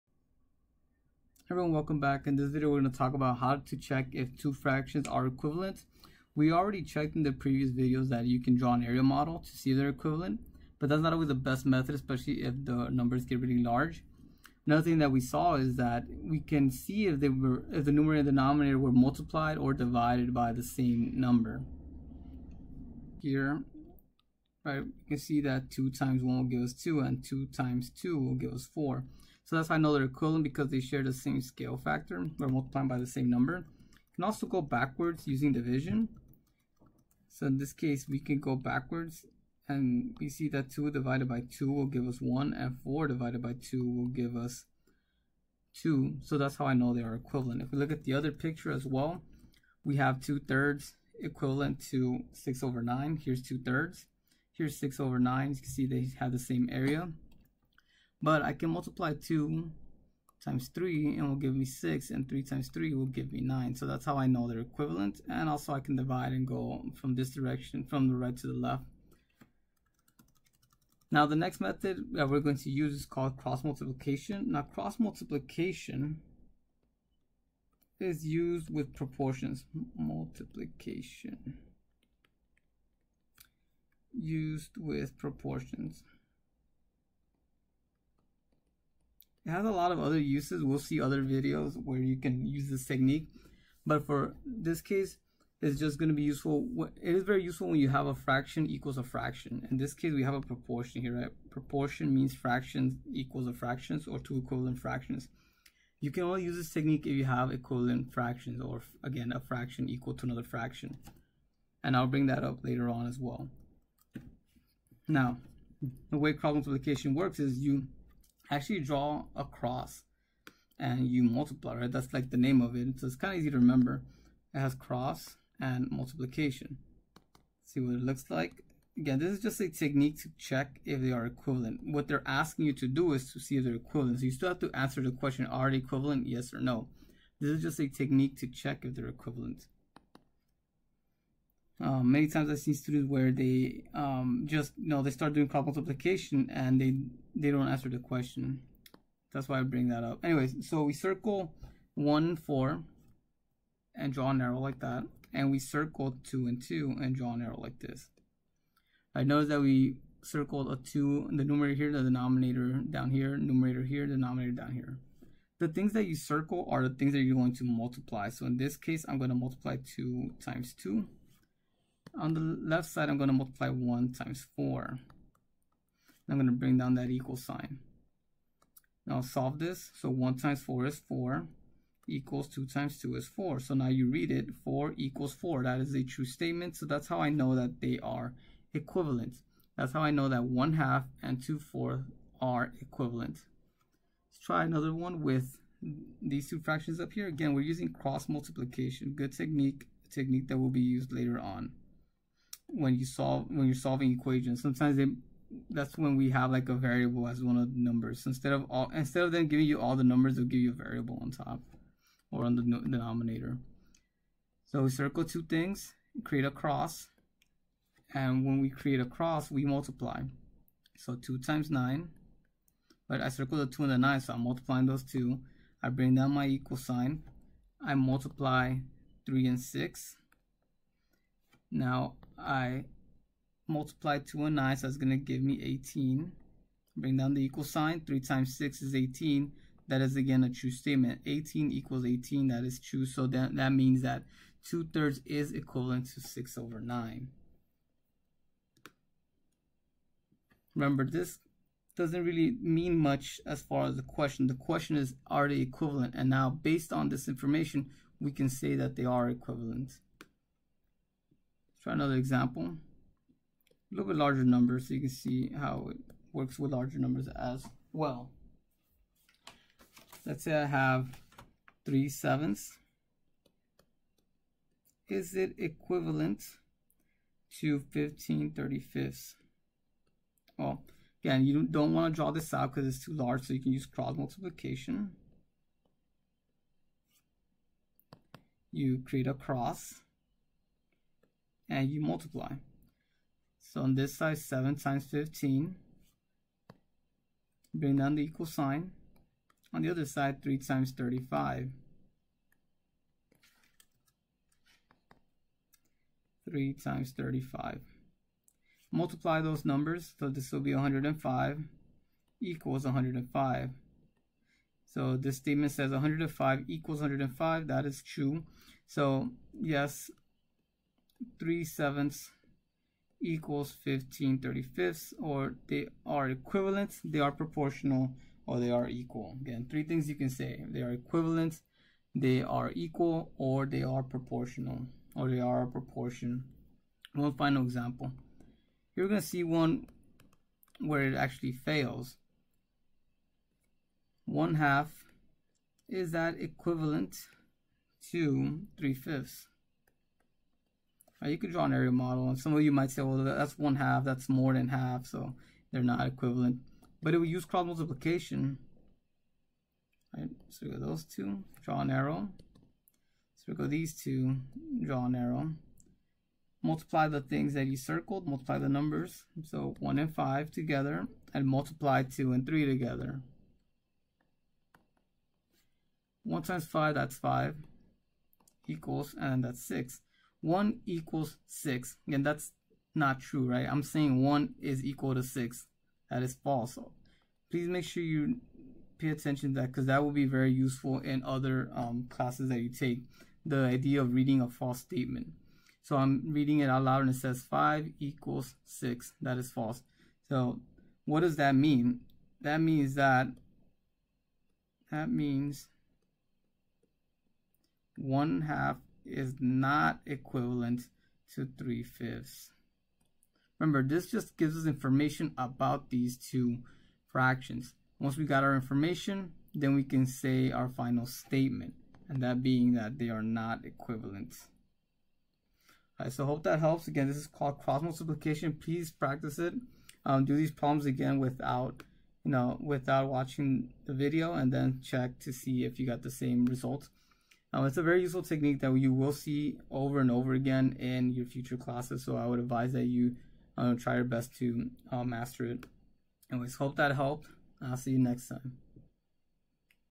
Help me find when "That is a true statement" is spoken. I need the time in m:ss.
3:05.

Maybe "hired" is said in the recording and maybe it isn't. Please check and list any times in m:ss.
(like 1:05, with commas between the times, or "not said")
not said.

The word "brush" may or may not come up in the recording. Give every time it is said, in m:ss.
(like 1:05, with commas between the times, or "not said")
not said.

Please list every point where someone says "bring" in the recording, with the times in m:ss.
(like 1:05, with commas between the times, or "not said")
1:52, 2:29, 2:56, 3:45, 3:56, 4:57.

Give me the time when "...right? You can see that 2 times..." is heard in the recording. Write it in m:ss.
0:24.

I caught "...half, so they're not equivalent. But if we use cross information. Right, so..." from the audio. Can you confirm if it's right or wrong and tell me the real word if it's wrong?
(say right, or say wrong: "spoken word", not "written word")
wrong: "multiplication", not "information".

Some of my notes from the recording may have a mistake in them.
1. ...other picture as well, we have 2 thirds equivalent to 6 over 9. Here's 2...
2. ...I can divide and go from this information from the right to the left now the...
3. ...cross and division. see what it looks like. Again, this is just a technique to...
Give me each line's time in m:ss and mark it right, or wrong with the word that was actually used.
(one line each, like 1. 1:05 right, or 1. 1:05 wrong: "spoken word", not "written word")
1. 0:48 right
2. 1:05 wrong: "direction", not "information"
3. 2:04 wrong: "multiplication", not "division".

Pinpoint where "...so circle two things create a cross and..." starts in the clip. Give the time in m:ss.
3:34.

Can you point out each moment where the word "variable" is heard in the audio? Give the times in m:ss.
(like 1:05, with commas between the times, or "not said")
3:26, 3:30.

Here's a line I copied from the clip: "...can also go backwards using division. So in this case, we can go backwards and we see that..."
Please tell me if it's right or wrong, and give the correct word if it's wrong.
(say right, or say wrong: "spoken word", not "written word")
right.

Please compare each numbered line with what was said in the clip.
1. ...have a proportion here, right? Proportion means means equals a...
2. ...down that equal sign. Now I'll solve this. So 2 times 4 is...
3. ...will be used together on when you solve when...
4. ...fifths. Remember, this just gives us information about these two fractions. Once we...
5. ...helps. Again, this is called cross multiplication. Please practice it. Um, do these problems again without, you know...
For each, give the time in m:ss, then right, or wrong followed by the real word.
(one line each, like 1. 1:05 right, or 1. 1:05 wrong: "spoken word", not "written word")
1. 1:40 wrong: "fractions", not "means"
2. 2:56 wrong: "1", not "2"
3. 3:20 wrong: "later", not "together"
4. 6:51 right
5. 7:06 right.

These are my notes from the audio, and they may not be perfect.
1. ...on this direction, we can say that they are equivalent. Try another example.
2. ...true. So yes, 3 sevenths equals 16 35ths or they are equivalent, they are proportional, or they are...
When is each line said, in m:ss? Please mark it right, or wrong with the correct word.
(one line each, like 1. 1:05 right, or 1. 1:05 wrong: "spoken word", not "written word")
1. 4:16 wrong: "information", not "direction"
2. 5:18 wrong: "15", not "16".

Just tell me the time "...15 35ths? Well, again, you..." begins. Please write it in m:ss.
4:37.